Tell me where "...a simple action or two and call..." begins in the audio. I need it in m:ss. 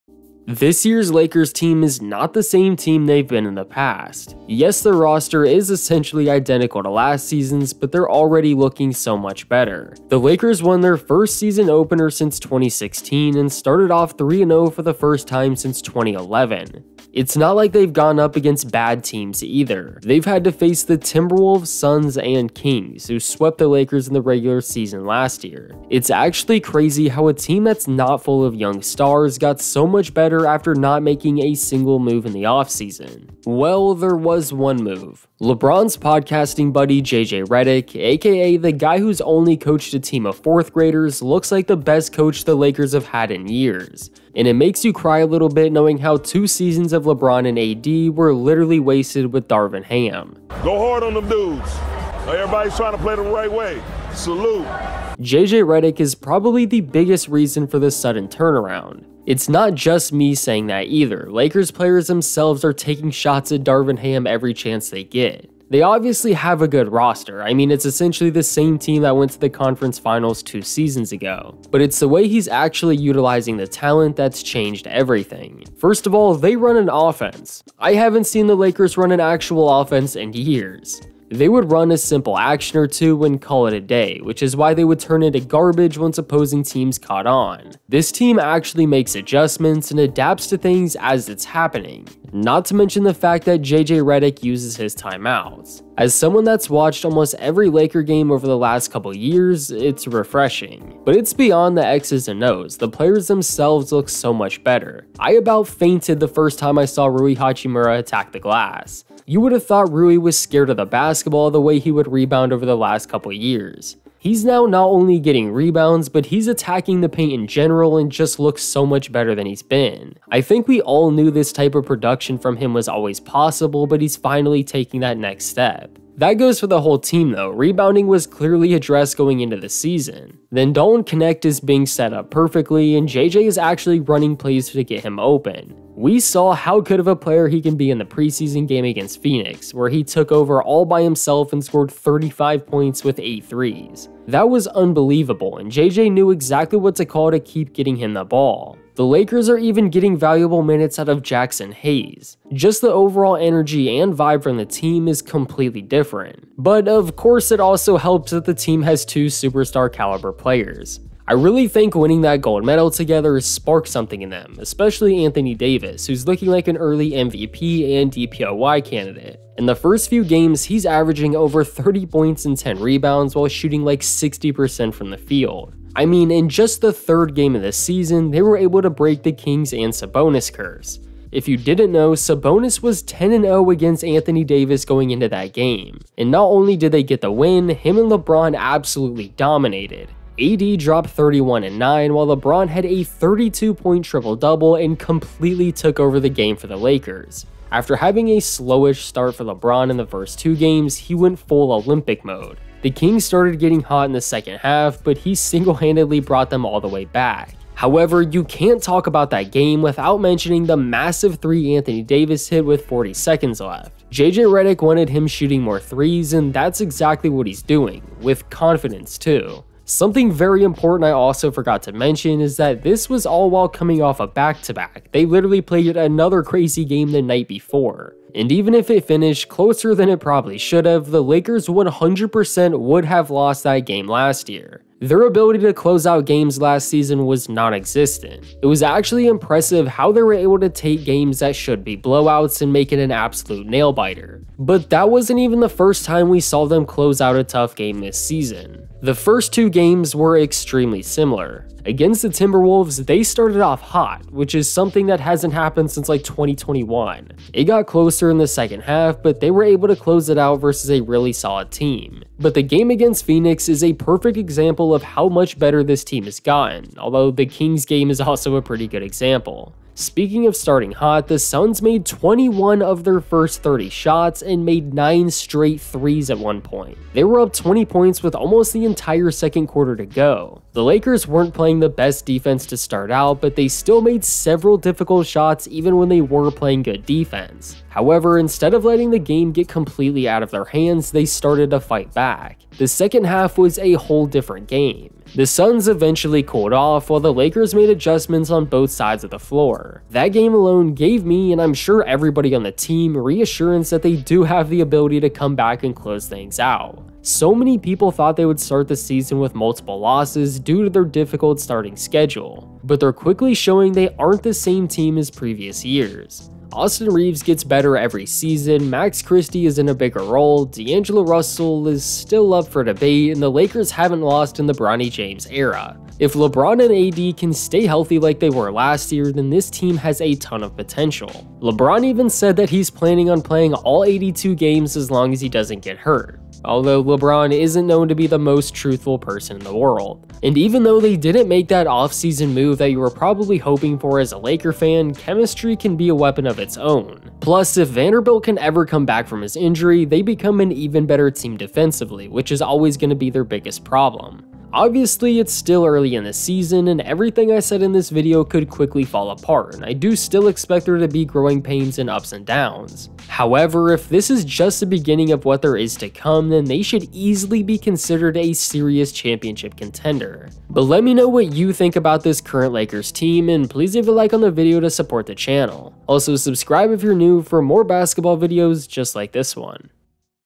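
1:21.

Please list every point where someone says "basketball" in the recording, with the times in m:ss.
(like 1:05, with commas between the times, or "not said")
1:50, 6:17.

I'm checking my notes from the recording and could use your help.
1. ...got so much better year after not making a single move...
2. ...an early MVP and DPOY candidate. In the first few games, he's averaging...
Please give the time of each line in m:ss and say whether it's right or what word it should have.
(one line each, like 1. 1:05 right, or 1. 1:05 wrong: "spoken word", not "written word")
1. 0:29 right
2. 2:46 right.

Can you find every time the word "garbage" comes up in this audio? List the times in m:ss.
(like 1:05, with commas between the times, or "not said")
1:25.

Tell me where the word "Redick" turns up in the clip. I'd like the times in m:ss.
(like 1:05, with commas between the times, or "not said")
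0:37, 0:55, 1:34, 3:34.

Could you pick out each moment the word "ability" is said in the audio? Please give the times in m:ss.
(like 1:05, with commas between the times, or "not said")
3:55, 5:04.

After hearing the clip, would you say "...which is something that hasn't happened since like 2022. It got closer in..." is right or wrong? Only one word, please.
wrong.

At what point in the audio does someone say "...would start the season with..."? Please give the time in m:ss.
5:08.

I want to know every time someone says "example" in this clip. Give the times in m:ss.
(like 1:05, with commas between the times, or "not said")
4:24, 4:29.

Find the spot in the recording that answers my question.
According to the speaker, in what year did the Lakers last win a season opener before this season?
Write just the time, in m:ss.
0:12.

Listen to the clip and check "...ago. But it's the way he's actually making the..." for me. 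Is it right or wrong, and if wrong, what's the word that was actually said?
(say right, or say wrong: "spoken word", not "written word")
wrong: "utilizing", not "making".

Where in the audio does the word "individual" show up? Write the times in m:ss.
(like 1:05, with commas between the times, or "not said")
not said.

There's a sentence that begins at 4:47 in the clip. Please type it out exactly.
However, instead of letting the game get completely out of their hands, they started to fight back.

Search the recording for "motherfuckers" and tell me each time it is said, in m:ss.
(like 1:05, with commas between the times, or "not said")
not said.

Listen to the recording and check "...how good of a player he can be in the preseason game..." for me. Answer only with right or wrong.
right.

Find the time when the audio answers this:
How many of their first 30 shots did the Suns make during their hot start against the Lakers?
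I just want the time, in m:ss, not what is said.
4:32.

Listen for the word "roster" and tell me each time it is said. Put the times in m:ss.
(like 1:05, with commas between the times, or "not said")
0:04, 1:06.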